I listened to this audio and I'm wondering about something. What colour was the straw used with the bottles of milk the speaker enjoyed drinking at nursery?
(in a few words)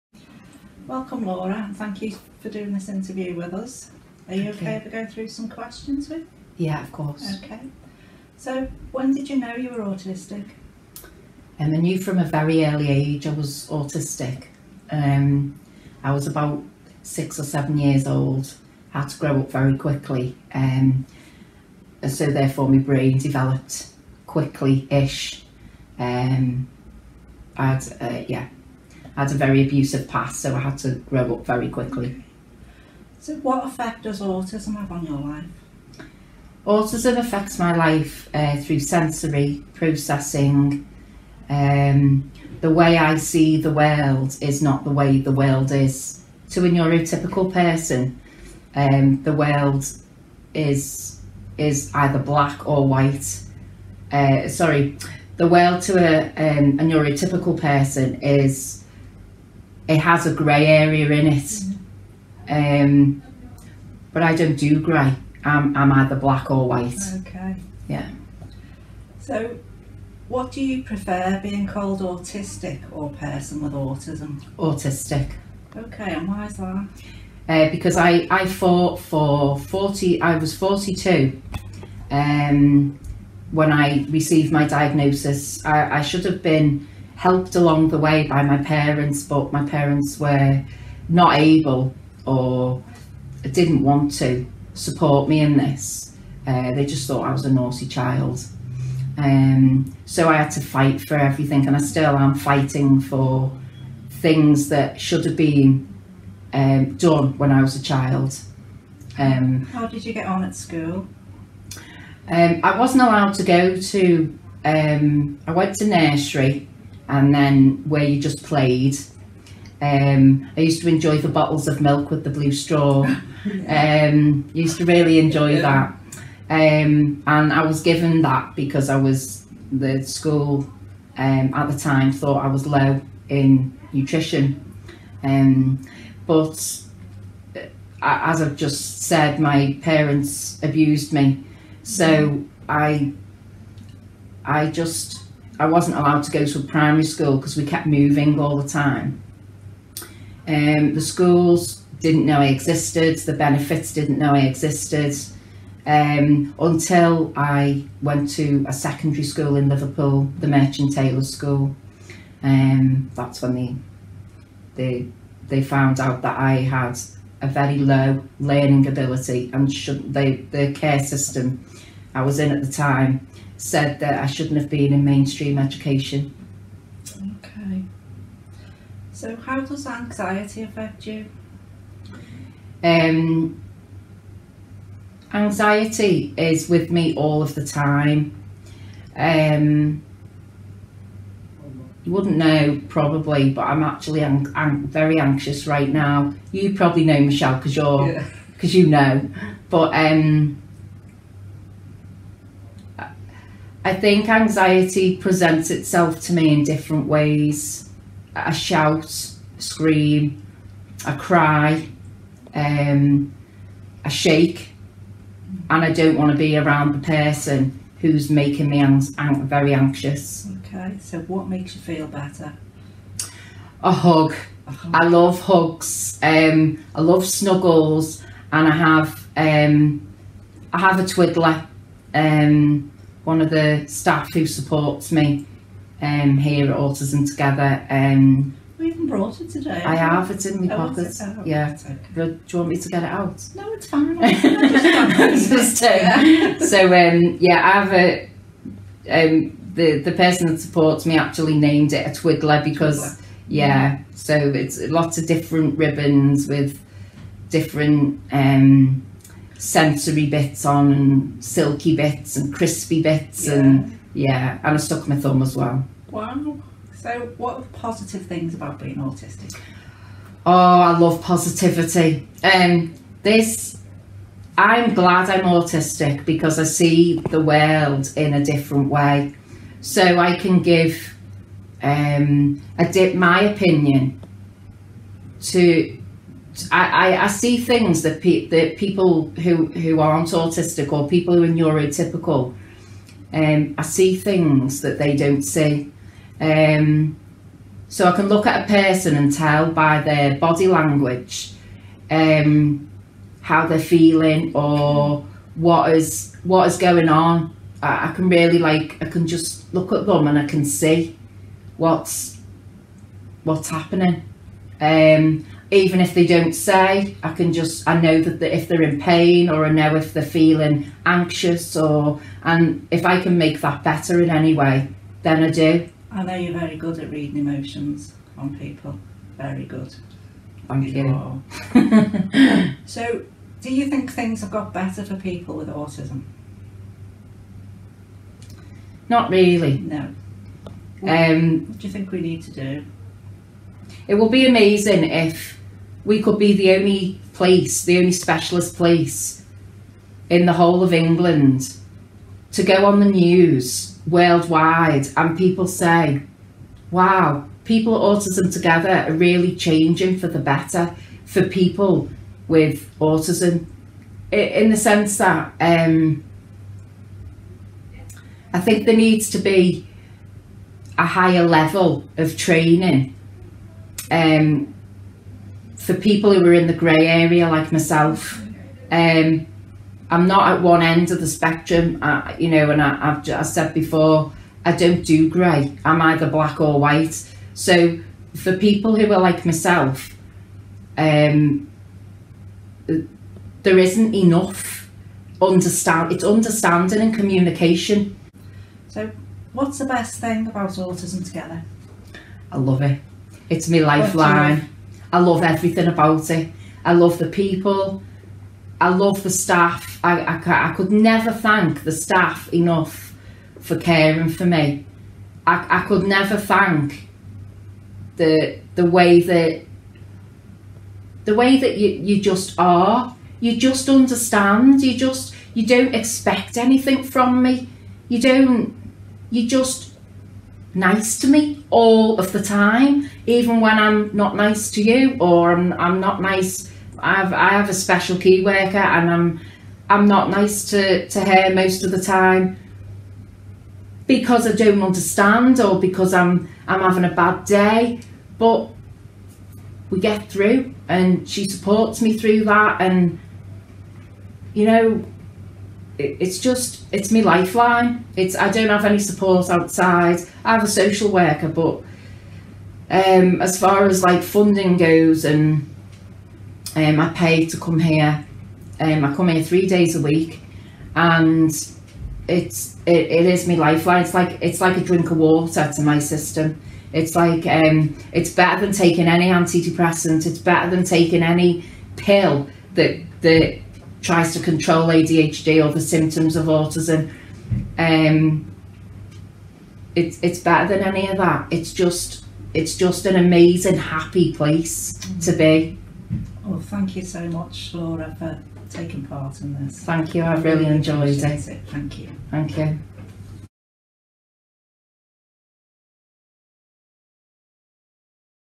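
Blue.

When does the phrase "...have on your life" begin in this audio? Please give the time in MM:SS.
00:34.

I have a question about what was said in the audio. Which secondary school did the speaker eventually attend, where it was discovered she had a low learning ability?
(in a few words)
Merchant Taylors School.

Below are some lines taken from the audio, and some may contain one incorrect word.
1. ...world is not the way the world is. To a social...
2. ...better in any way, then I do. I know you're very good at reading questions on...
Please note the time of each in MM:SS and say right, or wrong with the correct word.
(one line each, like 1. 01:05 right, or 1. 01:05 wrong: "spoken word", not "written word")
1. 00:43 wrong: "neurotypical", not "social"
2. 05:23 wrong: "emotions", not "questions".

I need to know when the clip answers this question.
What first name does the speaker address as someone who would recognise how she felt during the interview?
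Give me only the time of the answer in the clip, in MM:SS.
03:17.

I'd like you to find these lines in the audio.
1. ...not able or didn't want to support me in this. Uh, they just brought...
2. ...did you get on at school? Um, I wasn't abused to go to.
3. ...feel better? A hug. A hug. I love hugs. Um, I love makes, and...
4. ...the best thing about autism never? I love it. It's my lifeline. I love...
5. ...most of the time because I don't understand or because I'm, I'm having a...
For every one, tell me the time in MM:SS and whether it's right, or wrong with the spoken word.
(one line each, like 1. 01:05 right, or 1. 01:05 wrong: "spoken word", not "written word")
1. 01:31 wrong: "thought", not "brought"
2. 01:49 wrong: "allowed", not "abused"
3. 03:41 wrong: "snuggles", not "makes"
4. 06:39 wrong: "together", not "never"
5. 07:21 right.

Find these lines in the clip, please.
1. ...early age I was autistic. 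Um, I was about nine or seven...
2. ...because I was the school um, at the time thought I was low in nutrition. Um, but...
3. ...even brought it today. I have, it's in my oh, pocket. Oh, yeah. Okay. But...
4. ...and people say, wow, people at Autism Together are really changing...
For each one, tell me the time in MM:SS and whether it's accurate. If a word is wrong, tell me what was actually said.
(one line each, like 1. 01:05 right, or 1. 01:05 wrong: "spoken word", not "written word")
1. 00:12 wrong: "six", not "nine"
2. 02:08 right
3. 03:58 right
4. 05:55 right.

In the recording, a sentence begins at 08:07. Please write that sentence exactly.
Um, it's it's better than any of that.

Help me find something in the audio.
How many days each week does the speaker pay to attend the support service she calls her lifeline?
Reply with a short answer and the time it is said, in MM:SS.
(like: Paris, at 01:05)
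3, at 07:49.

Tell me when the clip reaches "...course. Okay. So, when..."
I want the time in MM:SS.
00:06.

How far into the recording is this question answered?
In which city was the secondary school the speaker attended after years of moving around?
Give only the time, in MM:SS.
02:39.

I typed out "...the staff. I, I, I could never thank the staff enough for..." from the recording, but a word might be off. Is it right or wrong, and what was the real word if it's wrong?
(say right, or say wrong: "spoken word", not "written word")
right.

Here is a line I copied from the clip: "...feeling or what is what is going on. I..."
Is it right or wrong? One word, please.
right.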